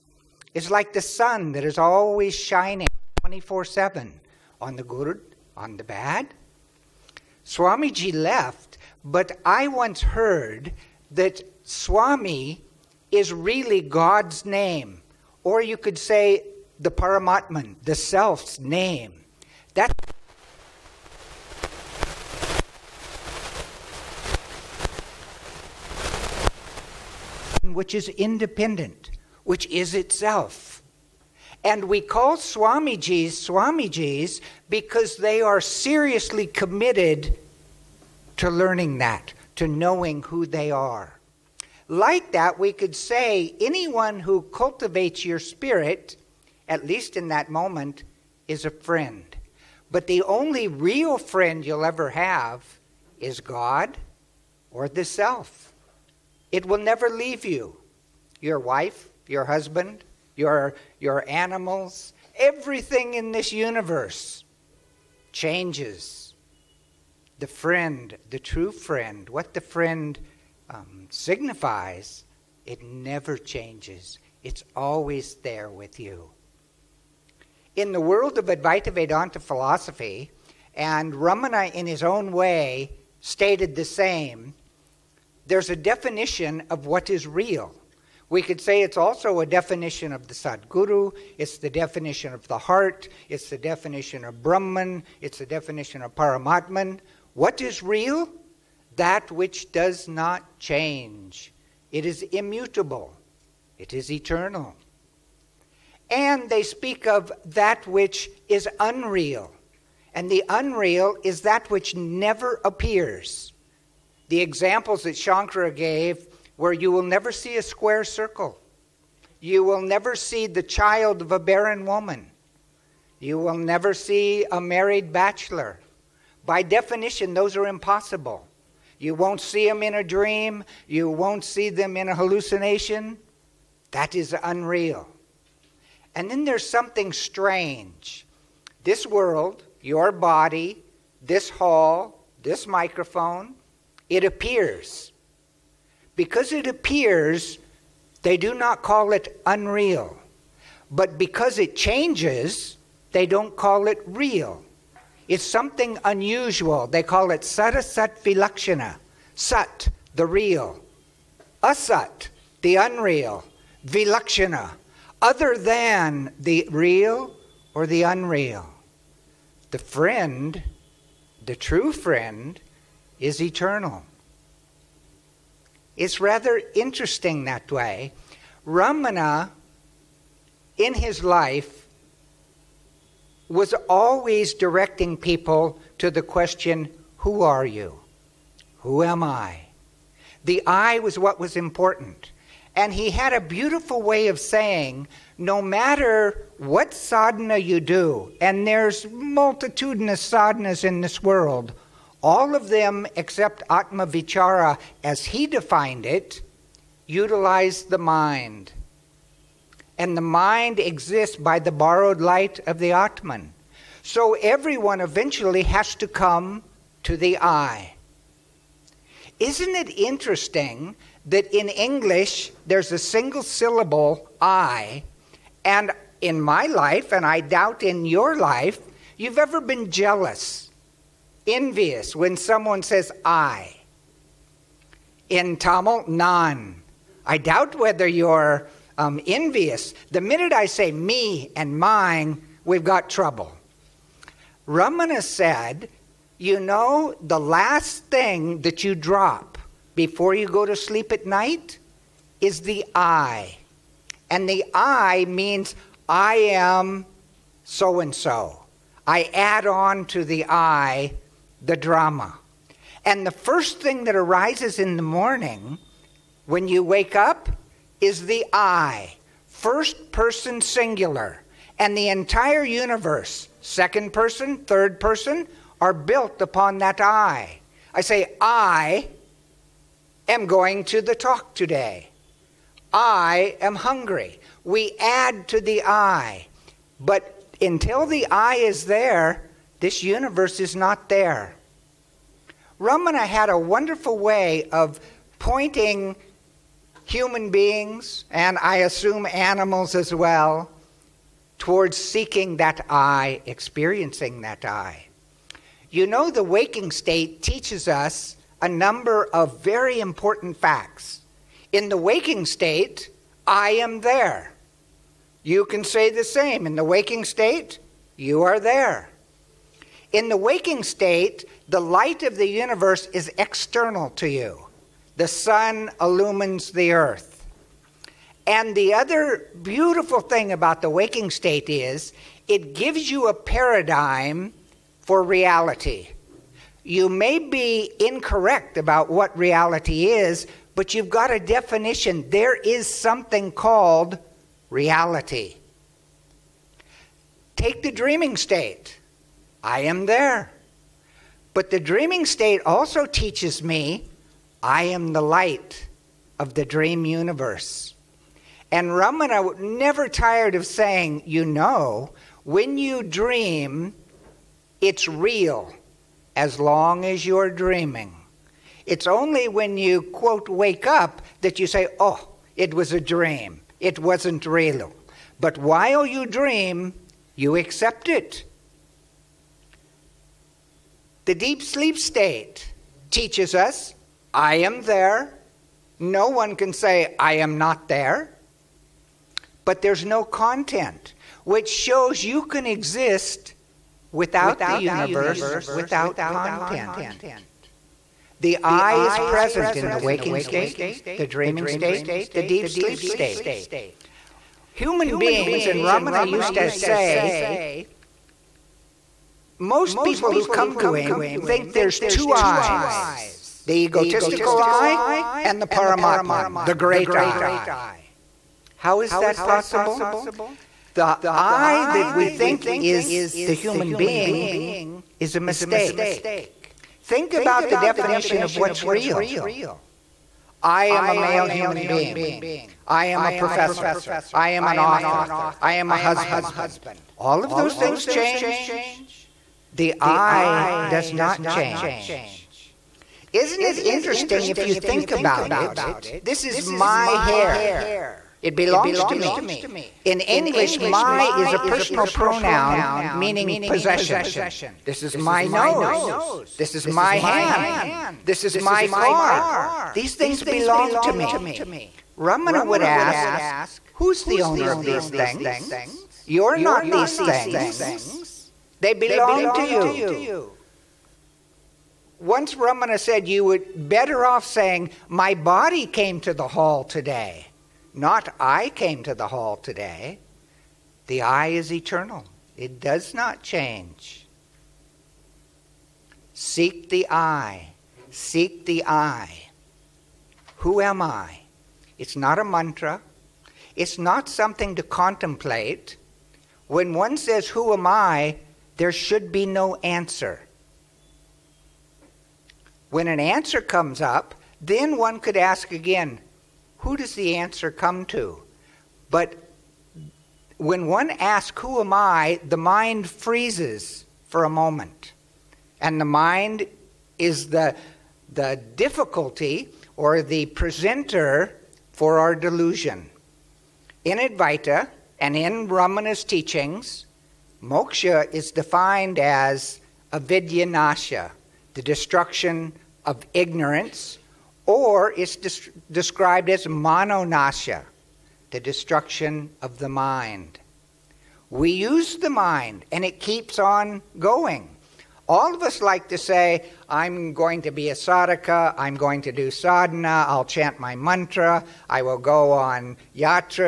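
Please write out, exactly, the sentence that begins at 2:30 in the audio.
But because it changes, they don't call it real.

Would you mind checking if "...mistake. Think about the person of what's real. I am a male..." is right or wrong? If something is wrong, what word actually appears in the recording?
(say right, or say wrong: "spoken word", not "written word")
wrong: "definition", not "person".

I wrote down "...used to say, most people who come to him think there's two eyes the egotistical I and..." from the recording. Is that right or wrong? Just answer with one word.
right.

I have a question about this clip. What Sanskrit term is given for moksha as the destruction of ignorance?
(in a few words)
avidyanasha.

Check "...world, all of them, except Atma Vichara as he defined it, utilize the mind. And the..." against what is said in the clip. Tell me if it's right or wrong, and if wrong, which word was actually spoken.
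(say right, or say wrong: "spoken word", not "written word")
right.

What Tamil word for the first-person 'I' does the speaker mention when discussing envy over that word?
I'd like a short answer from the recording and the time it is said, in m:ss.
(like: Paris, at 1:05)
nan, at 3:56.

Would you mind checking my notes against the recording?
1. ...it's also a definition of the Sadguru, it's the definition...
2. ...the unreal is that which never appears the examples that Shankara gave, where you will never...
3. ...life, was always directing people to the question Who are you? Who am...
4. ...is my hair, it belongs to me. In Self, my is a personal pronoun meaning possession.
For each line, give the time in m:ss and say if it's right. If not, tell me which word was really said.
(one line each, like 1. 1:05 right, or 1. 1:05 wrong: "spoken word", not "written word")
1. 1:28 right
2. 1:50 right
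3. 3:01 right
4. 7:26 wrong: "English", not "Self".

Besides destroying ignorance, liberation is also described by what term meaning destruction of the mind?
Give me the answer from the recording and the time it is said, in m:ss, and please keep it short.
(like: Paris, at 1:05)
manonasha, at 8:56.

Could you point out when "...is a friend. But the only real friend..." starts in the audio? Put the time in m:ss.
0:48.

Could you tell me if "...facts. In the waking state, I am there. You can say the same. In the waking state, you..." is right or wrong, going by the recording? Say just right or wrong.
right.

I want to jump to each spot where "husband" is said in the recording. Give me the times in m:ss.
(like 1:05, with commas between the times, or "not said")
0:59, 7:15.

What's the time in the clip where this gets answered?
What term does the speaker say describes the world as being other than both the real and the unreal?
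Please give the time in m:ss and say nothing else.
2:37.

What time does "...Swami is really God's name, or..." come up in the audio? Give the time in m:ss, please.
0:11.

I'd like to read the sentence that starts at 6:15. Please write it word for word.
But while you dream, you accept it the deep sleep state teaches us I am there.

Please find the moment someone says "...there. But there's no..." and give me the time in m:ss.
6:27.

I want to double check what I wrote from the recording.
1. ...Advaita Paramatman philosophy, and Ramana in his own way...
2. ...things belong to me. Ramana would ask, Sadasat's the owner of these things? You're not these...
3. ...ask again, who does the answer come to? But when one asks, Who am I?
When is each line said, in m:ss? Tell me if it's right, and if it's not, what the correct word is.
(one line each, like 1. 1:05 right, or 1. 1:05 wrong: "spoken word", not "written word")
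1. 1:18 wrong: "Vedanta", not "Paramatman"
2. 7:40 wrong: "Who", not "Sadasat"
3. 8:25 right.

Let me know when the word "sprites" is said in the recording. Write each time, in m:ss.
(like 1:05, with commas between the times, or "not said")
not said.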